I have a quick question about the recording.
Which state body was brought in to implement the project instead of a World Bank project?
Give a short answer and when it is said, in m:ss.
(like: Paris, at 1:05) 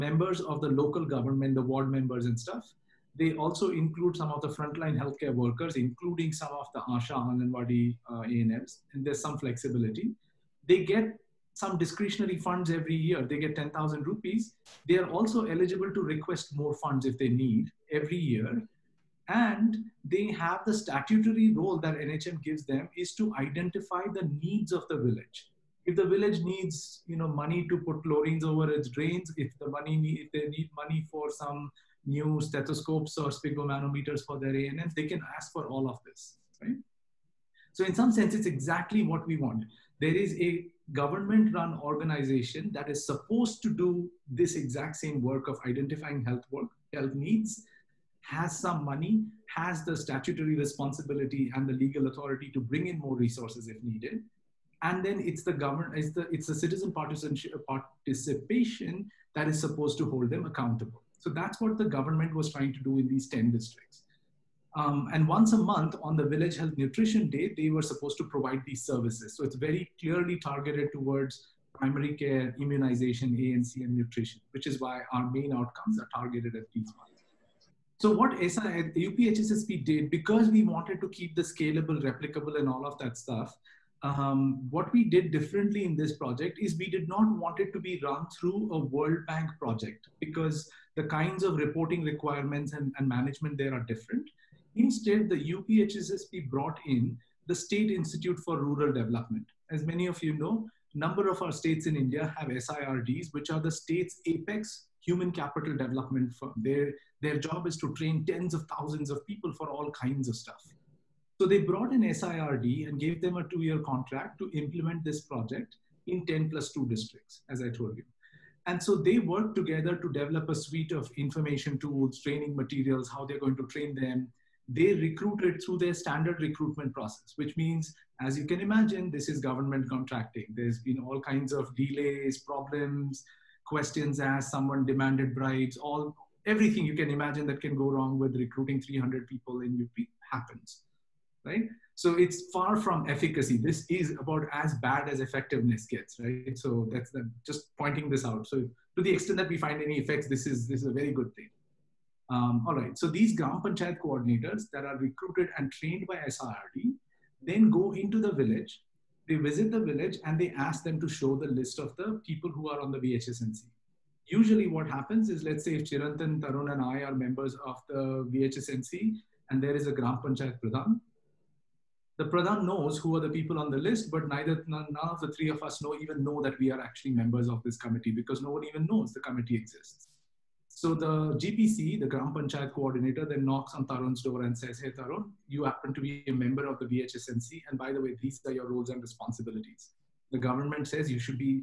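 State Institute for Rural Development, at 1:37.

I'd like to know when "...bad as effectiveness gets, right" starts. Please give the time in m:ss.
2:24.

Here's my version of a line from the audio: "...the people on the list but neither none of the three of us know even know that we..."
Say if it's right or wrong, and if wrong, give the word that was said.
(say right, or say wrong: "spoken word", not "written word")
right.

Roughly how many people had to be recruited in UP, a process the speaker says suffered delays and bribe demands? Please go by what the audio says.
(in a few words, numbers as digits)
300.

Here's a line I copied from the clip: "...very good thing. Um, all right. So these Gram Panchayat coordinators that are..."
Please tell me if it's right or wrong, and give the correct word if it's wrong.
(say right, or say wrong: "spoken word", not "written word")
right.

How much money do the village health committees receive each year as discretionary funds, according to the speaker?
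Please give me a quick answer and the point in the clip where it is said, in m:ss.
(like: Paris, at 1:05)
10,000 rupees, at 0:13.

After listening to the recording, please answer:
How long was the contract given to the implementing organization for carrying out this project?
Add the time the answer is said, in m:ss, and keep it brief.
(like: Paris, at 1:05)
two year, at 1:53.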